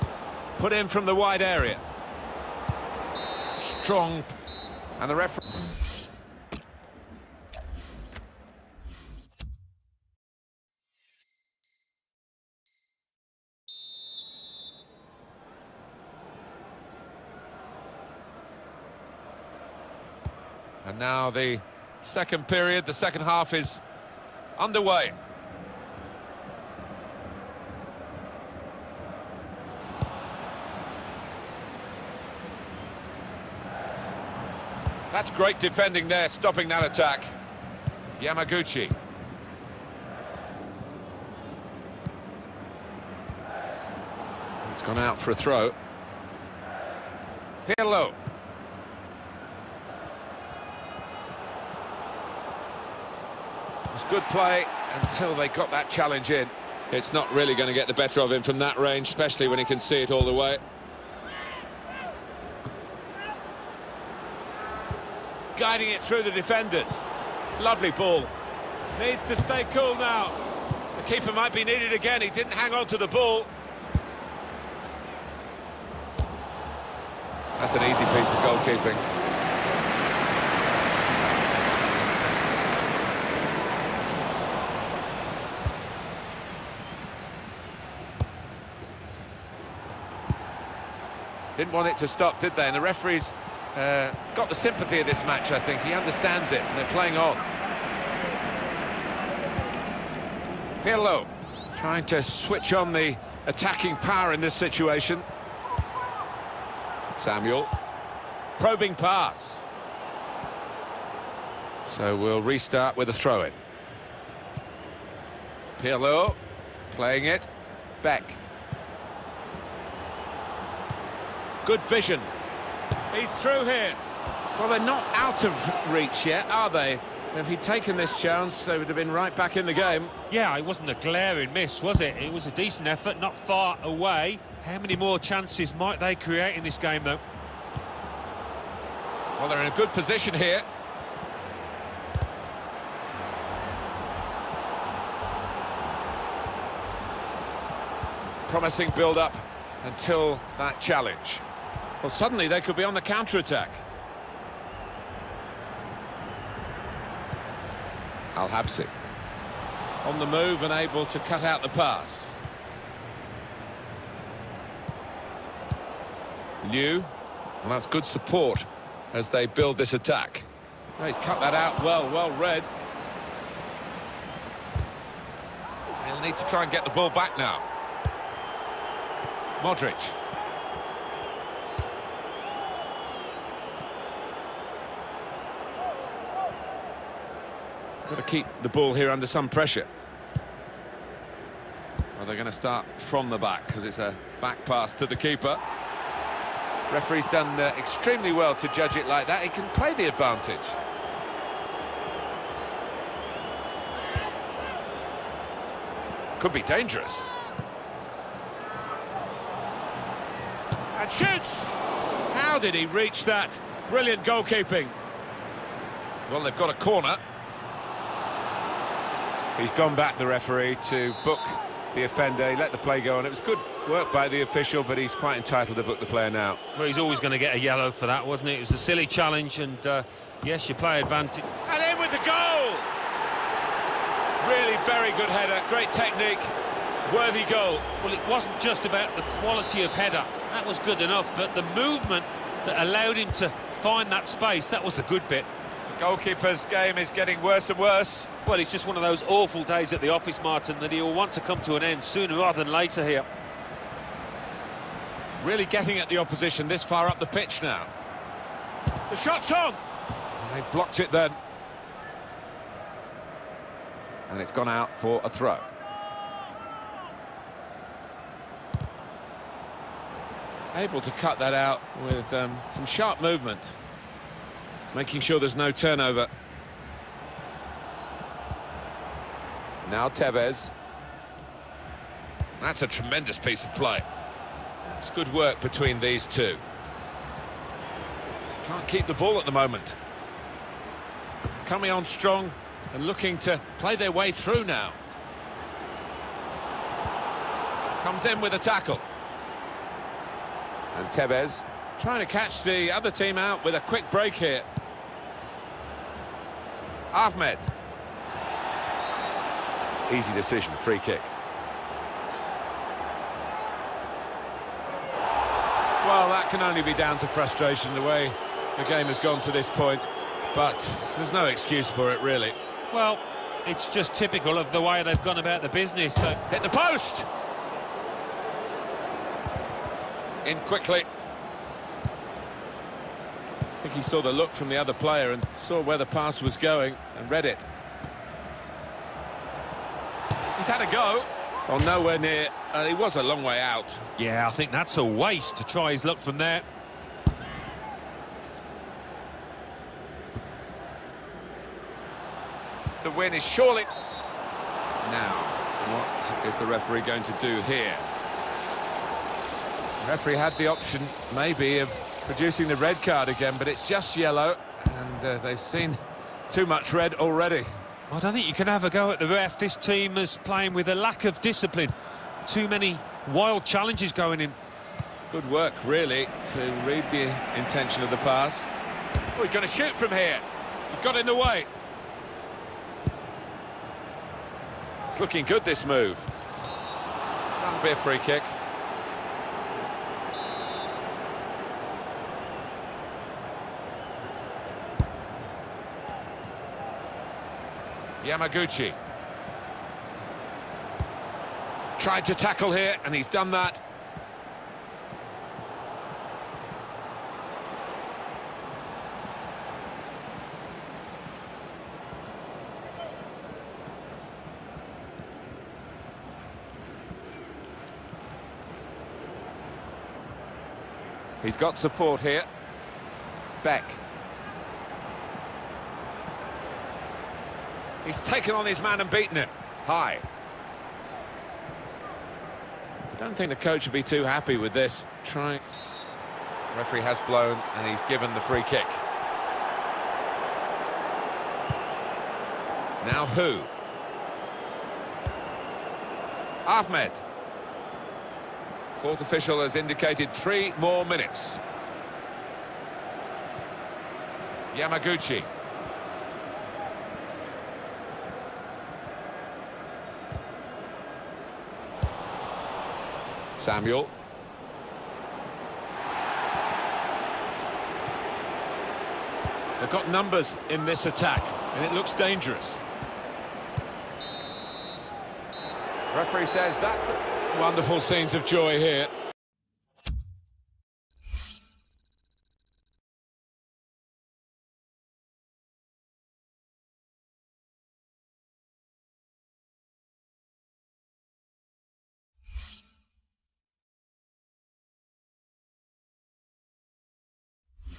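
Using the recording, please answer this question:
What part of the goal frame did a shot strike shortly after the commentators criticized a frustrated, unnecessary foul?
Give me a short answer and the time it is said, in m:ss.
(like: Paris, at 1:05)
The post, at 5:26.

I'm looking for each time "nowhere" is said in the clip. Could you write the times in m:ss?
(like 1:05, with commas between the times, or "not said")
5:41.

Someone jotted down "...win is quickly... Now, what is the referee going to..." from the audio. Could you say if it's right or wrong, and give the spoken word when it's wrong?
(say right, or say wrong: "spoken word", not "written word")
wrong: "surely", not "quickly".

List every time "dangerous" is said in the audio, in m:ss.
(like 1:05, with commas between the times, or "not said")
3:26, 7:52.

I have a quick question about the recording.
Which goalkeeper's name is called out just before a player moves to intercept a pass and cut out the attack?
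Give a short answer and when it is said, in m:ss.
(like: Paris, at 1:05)
Al Habsi, at 2:38.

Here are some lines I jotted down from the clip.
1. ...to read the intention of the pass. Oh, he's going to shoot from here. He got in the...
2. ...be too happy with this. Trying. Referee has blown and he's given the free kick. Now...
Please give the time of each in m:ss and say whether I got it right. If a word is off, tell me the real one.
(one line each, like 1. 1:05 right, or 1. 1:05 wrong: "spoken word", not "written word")
1. 6:16 right
2. 7:13 right.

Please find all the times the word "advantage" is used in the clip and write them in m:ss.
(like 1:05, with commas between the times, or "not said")
3:20, 3:50.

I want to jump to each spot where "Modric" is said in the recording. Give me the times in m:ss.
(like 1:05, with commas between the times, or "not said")
2:59.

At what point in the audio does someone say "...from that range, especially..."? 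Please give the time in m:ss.
0:58.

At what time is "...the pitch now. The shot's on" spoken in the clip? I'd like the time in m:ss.
4:17.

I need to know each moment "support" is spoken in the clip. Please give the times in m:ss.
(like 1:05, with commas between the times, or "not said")
2:48, 7:01.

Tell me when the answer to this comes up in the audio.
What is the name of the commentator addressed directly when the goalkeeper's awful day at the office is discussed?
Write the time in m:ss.
4:10.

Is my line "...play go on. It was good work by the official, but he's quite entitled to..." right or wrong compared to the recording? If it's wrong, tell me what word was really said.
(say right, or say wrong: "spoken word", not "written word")
right.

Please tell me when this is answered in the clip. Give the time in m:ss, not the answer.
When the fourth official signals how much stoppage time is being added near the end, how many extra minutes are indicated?
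7:30.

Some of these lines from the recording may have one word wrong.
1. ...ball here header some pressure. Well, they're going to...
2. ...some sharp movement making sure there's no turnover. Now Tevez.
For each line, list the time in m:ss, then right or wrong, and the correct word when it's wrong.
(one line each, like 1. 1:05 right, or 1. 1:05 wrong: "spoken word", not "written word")
1. 3:08 wrong: "under", not "header"
2. 4:32 right.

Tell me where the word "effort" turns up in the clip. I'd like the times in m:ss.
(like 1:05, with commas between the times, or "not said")
2:12.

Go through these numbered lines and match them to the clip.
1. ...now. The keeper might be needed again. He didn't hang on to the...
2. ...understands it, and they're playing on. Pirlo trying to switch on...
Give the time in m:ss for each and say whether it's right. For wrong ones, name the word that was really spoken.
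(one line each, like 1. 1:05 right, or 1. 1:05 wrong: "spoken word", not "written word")
1. 1:09 right
2. 1:35 right.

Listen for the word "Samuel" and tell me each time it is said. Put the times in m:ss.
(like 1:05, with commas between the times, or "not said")
1:47, 7:43.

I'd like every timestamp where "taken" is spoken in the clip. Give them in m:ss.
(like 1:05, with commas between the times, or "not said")
2:07, 7:08.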